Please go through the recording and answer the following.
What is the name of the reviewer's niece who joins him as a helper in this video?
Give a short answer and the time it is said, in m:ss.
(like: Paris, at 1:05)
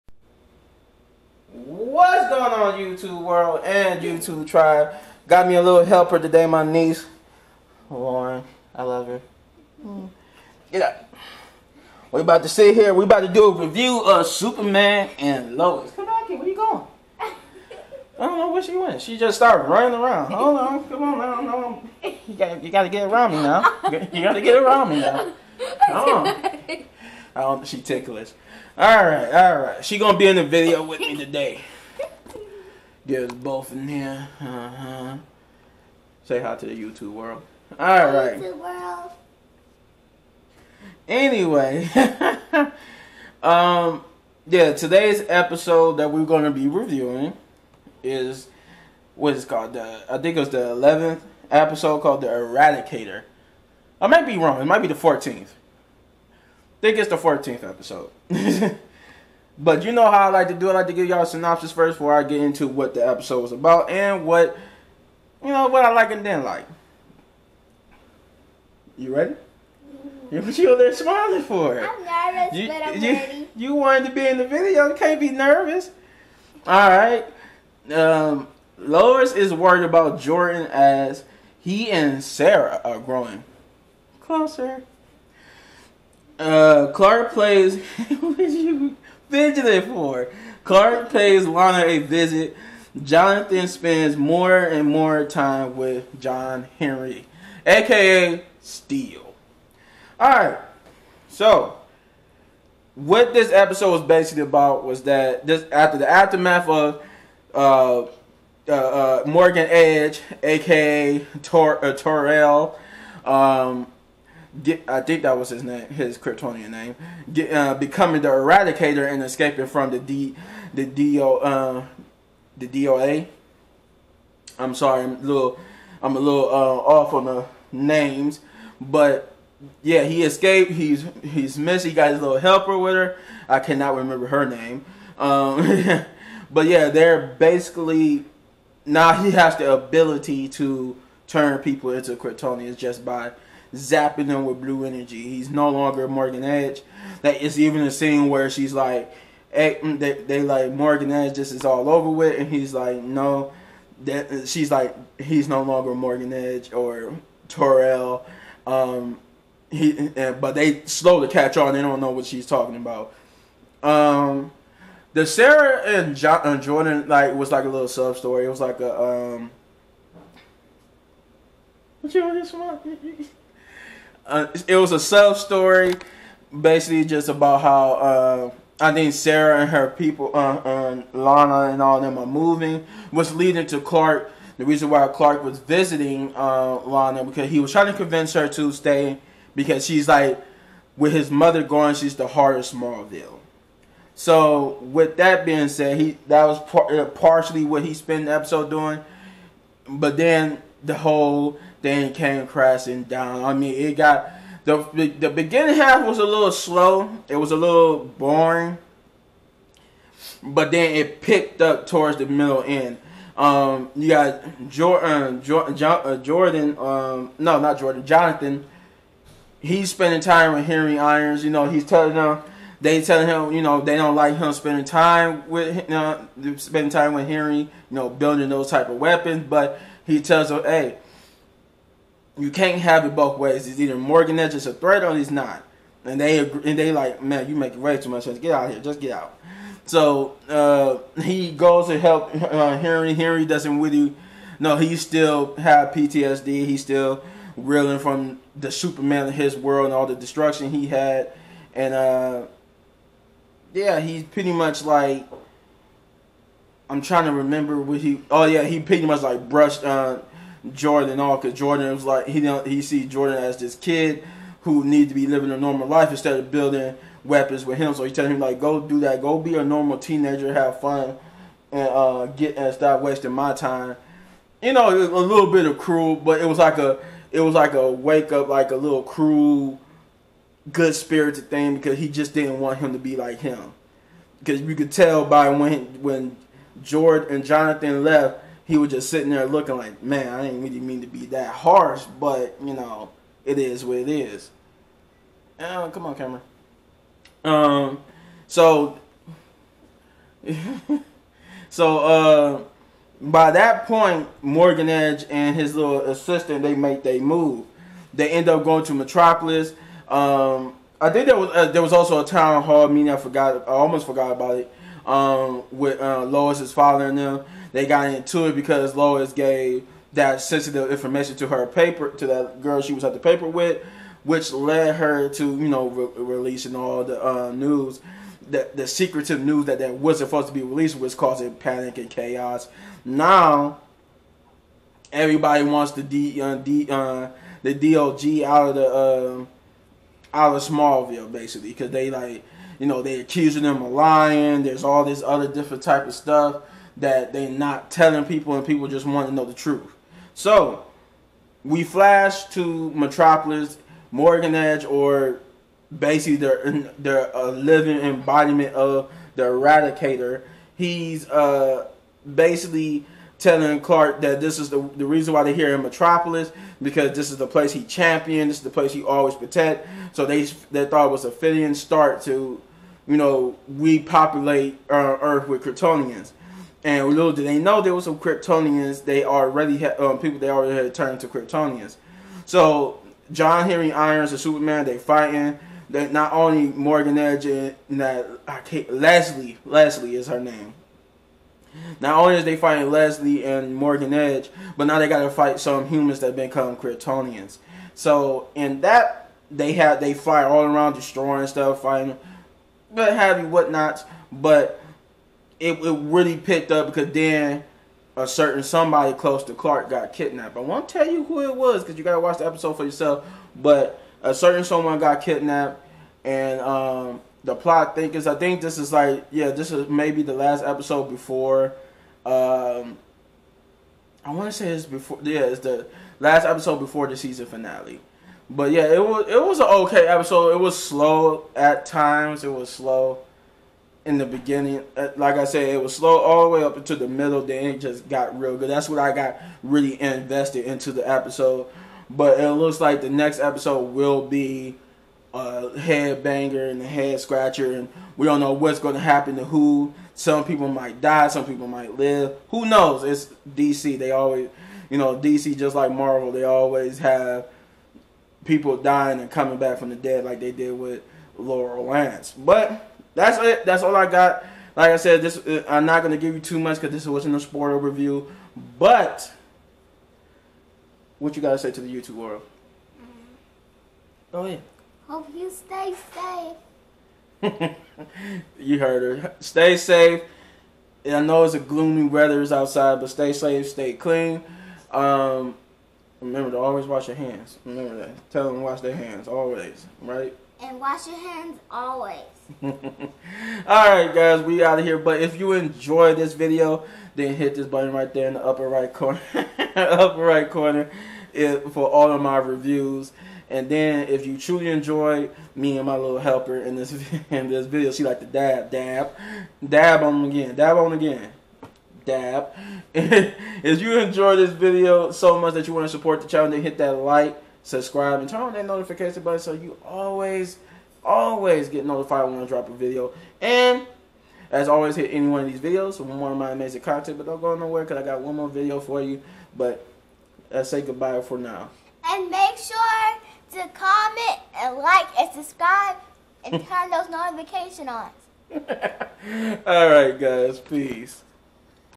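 Lauren, at 0:07.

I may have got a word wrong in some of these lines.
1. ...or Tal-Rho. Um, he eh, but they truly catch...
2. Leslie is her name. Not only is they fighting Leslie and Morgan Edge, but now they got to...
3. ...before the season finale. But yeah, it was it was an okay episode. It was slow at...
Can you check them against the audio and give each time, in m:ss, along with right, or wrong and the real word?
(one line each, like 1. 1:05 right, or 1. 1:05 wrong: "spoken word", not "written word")
1. 2:36 wrong: "slowly", not "truly"
2. 6:29 right
3. 7:06 right.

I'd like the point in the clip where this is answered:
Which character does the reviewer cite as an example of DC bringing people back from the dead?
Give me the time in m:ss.
7:41.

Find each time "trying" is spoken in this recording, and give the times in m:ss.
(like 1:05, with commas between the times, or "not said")
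3:07, 4:17.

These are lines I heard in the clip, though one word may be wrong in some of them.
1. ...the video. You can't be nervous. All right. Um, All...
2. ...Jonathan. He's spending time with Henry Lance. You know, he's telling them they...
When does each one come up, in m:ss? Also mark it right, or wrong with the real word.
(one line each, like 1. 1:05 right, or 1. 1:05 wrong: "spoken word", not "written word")
1. 1:14 wrong: "Lois", not "All"
2. 3:38 wrong: "Irons", not "Lance".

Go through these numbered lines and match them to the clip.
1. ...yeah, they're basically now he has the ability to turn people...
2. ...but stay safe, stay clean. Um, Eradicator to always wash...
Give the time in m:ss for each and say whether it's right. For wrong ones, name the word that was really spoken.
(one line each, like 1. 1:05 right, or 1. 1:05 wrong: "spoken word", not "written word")
1. 2:16 right
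2. 8:03 wrong: "Remember", not "Eradicator".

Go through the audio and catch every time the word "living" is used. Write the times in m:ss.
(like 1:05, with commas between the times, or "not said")
4:25, 5:57.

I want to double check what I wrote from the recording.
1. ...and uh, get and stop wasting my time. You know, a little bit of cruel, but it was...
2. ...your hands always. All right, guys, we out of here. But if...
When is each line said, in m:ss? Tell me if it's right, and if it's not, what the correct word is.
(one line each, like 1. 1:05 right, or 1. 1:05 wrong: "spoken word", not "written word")
1. 4:31 right
2. 8:11 right.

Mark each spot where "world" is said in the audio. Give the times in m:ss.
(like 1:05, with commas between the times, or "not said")
0:03, 0:37, 4:09, 7:52.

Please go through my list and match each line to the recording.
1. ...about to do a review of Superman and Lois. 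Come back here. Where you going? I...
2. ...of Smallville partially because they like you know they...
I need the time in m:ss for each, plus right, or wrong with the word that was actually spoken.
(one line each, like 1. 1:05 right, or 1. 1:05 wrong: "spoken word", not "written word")
1. 0:13 right
2. 5:40 wrong: "basically", not "partially".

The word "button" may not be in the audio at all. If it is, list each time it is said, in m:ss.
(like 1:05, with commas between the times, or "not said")
8:17, 8:39.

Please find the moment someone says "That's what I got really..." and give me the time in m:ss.
7:18.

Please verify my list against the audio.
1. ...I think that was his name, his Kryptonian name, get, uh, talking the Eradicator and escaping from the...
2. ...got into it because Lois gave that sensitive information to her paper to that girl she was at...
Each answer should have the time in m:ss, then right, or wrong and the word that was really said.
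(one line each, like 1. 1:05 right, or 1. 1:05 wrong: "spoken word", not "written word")
1. 1:54 wrong: "becoming", not "talking"
2. 5:17 right.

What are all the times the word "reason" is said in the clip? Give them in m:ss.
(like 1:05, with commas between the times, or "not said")
3:04, 6:05.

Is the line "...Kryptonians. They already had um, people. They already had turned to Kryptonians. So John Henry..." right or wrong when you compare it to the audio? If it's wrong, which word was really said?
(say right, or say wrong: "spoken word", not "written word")
right.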